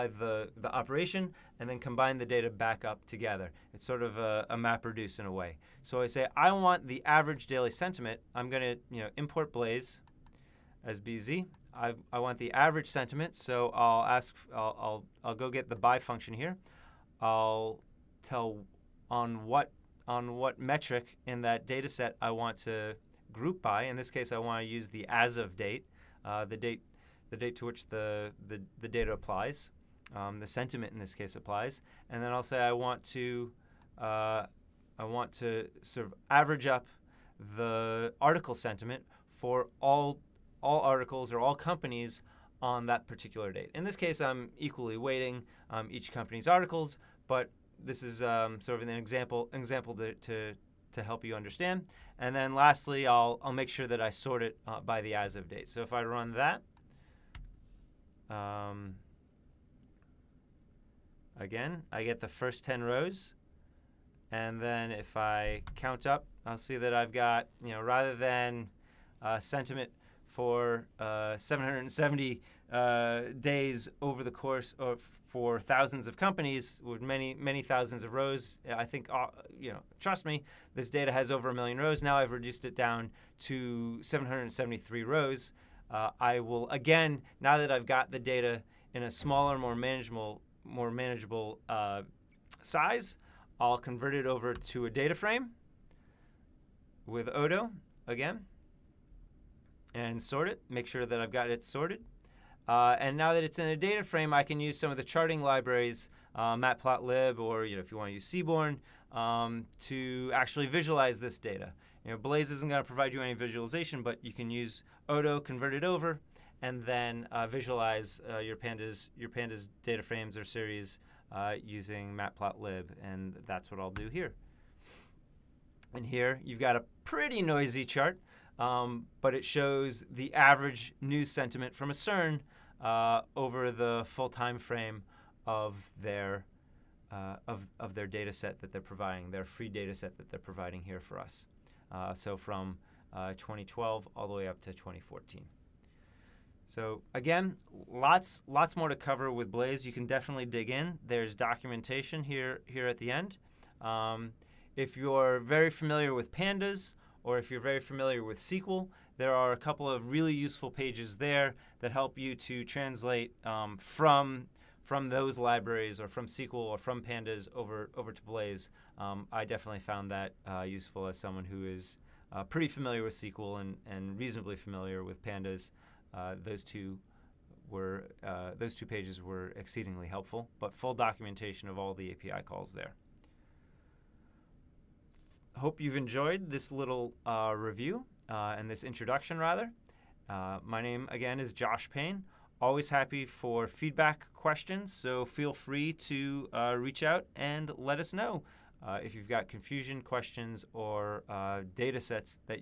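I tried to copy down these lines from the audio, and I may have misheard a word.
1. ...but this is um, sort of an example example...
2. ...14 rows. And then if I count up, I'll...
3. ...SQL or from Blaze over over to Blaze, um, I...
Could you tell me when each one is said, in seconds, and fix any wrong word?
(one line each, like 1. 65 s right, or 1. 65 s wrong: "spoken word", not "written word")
1. 47 s right
2. 62 s wrong: "10", not "14"
3. 166 s wrong: "Pandas", not "Blaze".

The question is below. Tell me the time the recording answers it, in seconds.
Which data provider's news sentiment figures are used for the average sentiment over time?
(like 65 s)
131 s.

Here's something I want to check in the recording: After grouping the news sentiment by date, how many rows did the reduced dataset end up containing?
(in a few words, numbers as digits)
773.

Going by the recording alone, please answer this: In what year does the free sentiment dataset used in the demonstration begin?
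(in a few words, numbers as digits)
2012.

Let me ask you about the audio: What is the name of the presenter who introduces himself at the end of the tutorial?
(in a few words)
Josh Payne.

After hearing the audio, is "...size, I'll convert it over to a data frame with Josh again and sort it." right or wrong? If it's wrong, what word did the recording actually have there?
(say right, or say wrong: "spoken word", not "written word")
wrong: "Odo", not "Josh".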